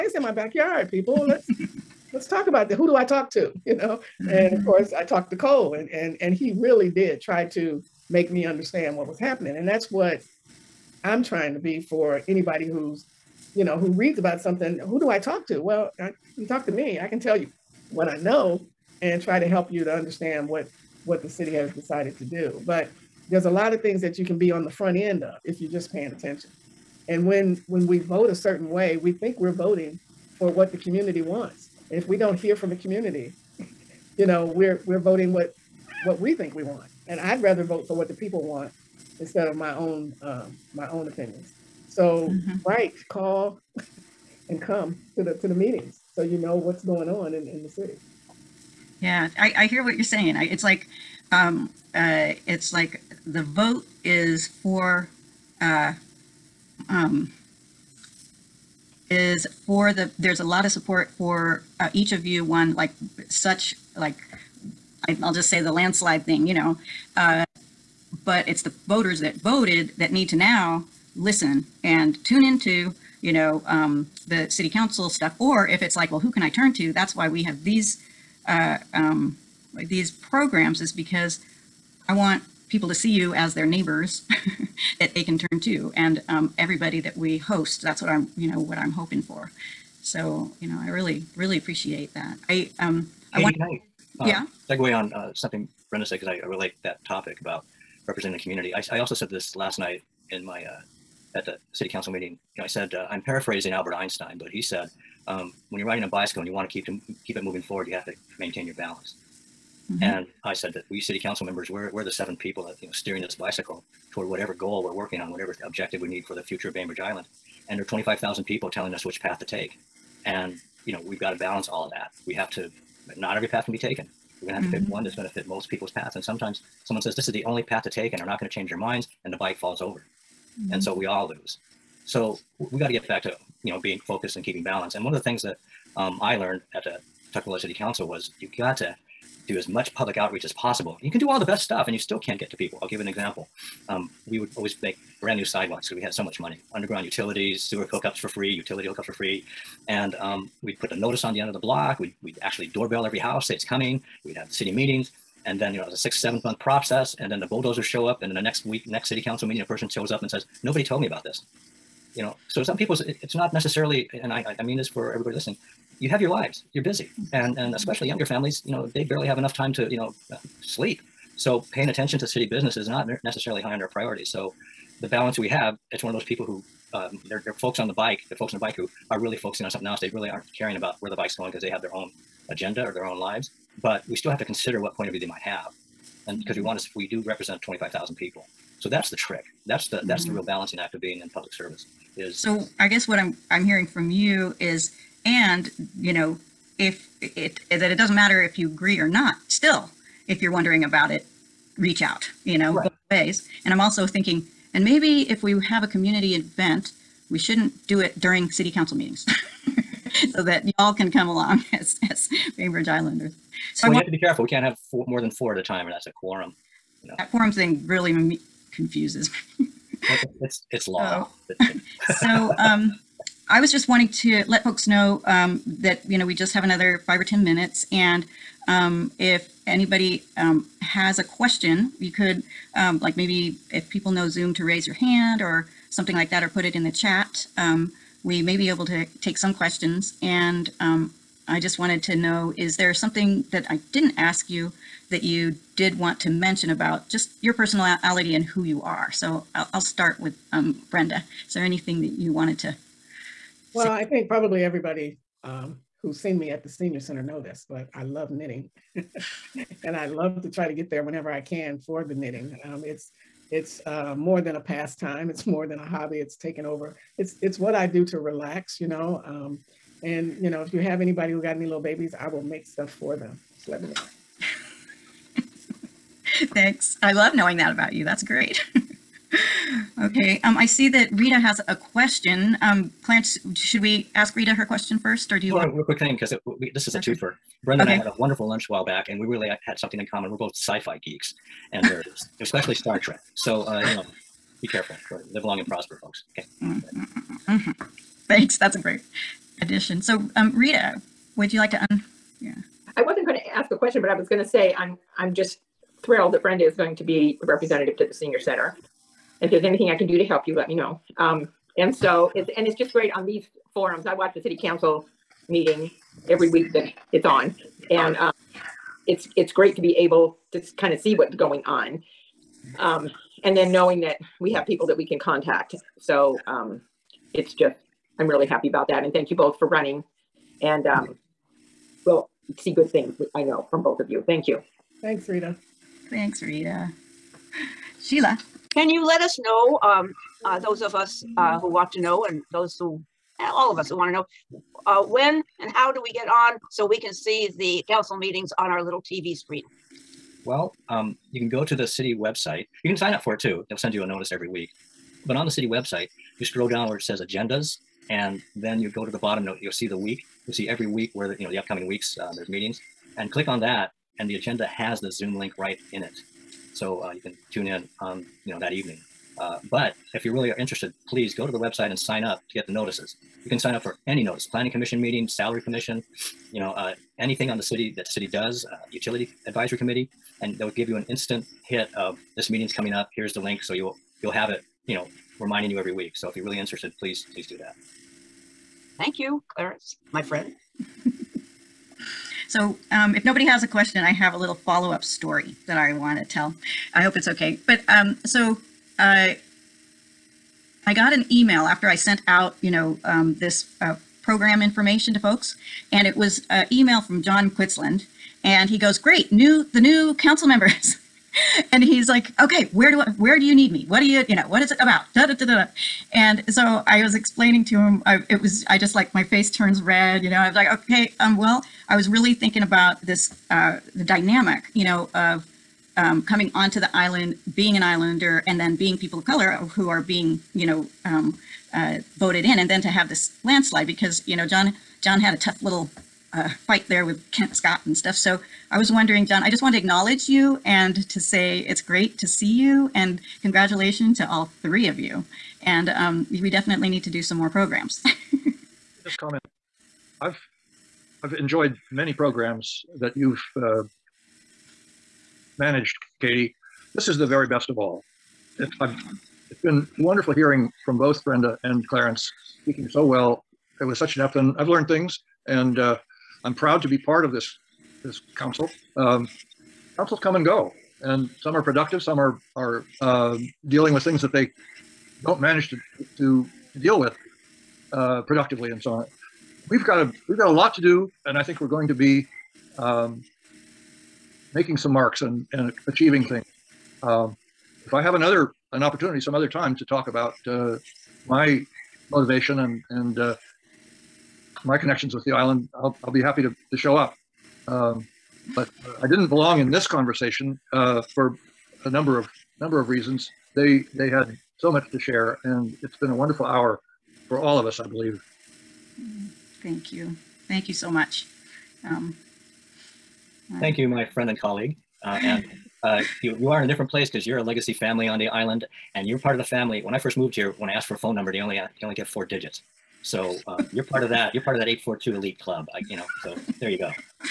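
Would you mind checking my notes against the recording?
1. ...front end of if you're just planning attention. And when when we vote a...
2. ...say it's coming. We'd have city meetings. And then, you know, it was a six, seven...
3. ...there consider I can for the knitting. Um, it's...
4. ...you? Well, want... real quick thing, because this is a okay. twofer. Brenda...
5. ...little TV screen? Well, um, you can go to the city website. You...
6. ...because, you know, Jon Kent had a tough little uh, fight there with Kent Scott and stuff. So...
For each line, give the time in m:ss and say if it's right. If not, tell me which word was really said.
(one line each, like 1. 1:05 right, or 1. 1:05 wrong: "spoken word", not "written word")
1. 0:24 wrong: "paying", not "planning"
2. 2:33 right
3. 4:20 wrong: "whenever", not "consider"
4. 4:45 right
5. 5:48 right
6. 7:13 wrong: "Jon", not "Kent".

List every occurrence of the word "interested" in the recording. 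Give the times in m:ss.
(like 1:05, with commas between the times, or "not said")
6:10, 6:26.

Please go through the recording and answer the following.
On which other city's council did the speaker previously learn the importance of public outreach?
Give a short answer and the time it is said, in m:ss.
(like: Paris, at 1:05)
Tukwila, at 2:17.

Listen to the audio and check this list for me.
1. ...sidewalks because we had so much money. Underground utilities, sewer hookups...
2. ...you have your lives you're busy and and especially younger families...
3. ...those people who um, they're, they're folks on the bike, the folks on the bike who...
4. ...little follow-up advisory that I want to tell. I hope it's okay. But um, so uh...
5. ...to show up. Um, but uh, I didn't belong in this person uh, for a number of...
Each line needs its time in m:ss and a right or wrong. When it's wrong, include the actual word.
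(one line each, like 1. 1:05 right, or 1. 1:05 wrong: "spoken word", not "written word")
1. 2:25 right
2. 2:45 right
3. 2:56 right
4. 6:34 wrong: "story", not "advisory"
5. 8:16 wrong: "conversation", not "person".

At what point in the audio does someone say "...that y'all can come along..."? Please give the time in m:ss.
3:30.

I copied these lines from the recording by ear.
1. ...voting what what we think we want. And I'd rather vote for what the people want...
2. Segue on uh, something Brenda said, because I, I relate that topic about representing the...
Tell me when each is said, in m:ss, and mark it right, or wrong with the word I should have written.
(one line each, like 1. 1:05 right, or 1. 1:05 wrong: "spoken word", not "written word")
1. 0:34 right
2. 1:34 right.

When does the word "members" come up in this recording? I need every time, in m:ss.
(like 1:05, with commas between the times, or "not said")
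1:51, 6:50.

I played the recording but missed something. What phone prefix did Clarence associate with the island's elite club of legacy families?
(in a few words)
842.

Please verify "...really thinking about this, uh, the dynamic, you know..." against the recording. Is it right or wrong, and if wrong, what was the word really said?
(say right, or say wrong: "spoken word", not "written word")
right.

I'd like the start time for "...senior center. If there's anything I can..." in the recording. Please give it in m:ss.
5:08.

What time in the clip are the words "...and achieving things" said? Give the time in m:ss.
8:05.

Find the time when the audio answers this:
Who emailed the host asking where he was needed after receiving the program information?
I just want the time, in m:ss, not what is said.
6:47.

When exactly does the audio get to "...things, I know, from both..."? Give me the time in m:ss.
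5:32.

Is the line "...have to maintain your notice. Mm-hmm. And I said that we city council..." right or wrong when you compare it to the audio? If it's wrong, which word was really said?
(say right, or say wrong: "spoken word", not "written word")
wrong: "balance", not "notice".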